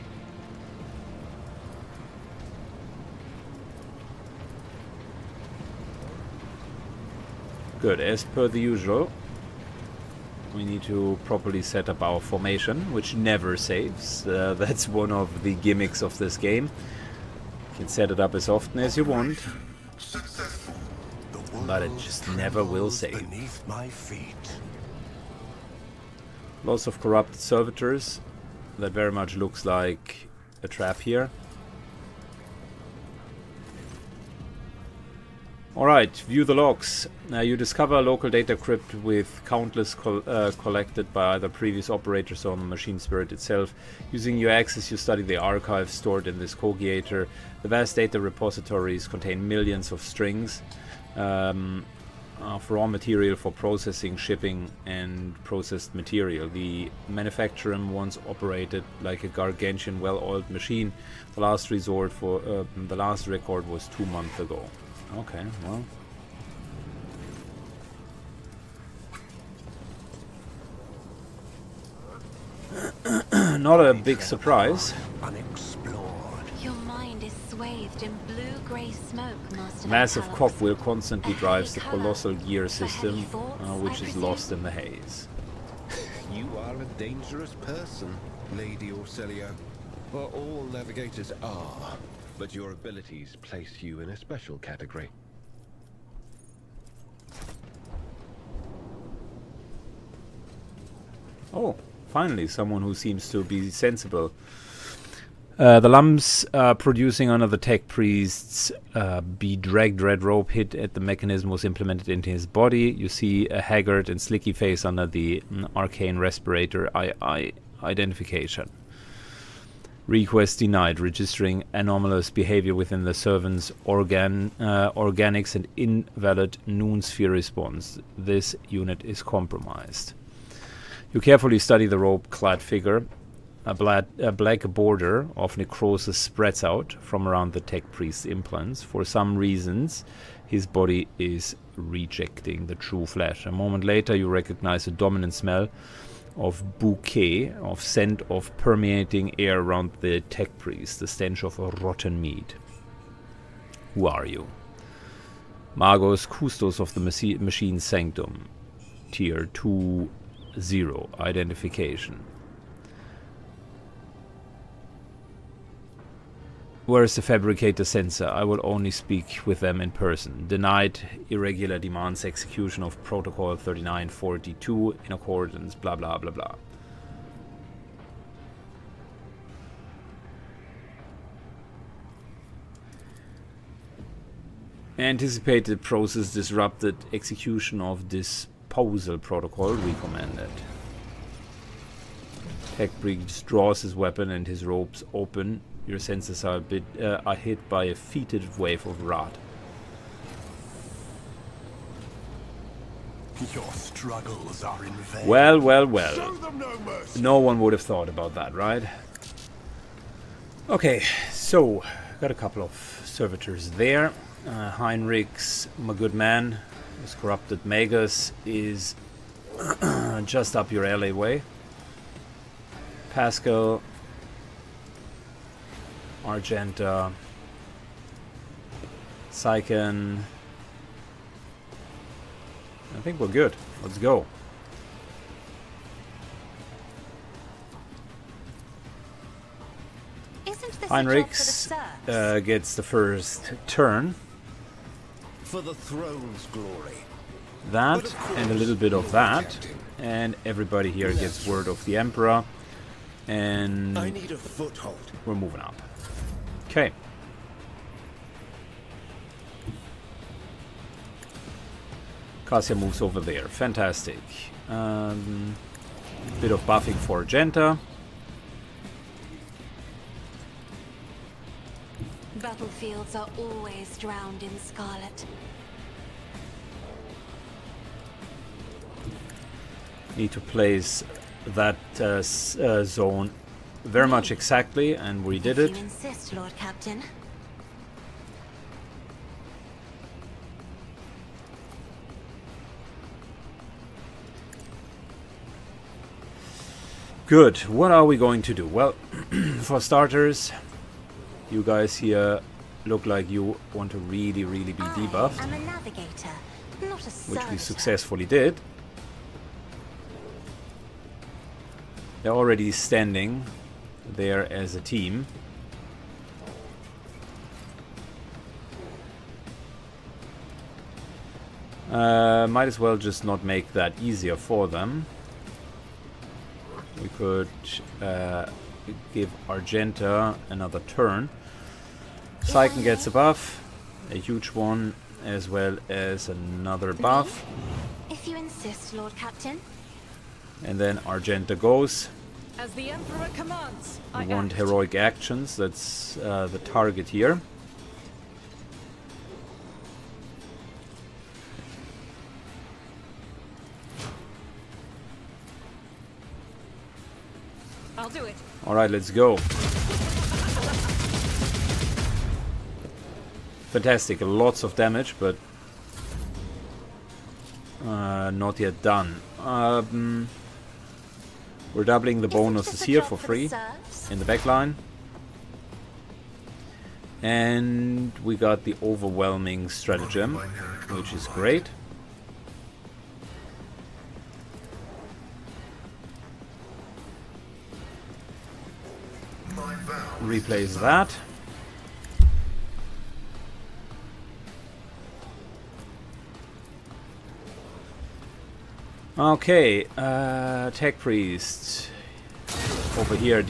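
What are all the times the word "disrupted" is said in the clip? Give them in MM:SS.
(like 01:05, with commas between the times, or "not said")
03:06.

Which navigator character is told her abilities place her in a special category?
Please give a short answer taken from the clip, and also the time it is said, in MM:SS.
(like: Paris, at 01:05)
Lady Orselia, at 01:28.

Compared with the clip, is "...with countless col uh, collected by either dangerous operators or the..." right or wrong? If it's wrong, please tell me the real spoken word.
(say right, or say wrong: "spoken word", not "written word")
wrong: "previous", not "dangerous".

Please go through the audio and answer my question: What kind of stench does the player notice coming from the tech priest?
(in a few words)
rotten meat.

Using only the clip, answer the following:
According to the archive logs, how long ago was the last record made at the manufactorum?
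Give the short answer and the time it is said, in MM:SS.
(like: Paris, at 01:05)
2 months ago, at 01:03.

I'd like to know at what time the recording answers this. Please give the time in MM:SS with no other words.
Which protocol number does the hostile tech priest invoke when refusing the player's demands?
02:53.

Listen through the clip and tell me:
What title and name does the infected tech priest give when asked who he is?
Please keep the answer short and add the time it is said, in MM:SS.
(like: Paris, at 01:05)
Magos Custos, at 02:35.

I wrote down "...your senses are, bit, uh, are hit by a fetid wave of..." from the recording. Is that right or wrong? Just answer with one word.
right.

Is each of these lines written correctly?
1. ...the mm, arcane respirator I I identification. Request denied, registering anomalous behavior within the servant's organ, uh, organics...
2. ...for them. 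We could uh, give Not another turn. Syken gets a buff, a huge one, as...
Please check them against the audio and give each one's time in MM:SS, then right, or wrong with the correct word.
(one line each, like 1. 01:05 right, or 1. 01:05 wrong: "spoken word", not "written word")
1. 01:55 right
2. 05:24 wrong: "Argenta", not "Not".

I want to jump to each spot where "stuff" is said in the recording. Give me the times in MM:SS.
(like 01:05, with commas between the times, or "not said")
not said.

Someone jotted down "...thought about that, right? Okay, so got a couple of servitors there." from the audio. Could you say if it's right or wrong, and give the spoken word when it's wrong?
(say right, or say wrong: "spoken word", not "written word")
right.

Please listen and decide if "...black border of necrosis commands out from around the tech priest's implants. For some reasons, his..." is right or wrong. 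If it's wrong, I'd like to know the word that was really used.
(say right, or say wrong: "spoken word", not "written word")
wrong: "spreads", not "commands".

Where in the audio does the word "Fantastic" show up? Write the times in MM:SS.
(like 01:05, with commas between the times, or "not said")
04:23, 06:03.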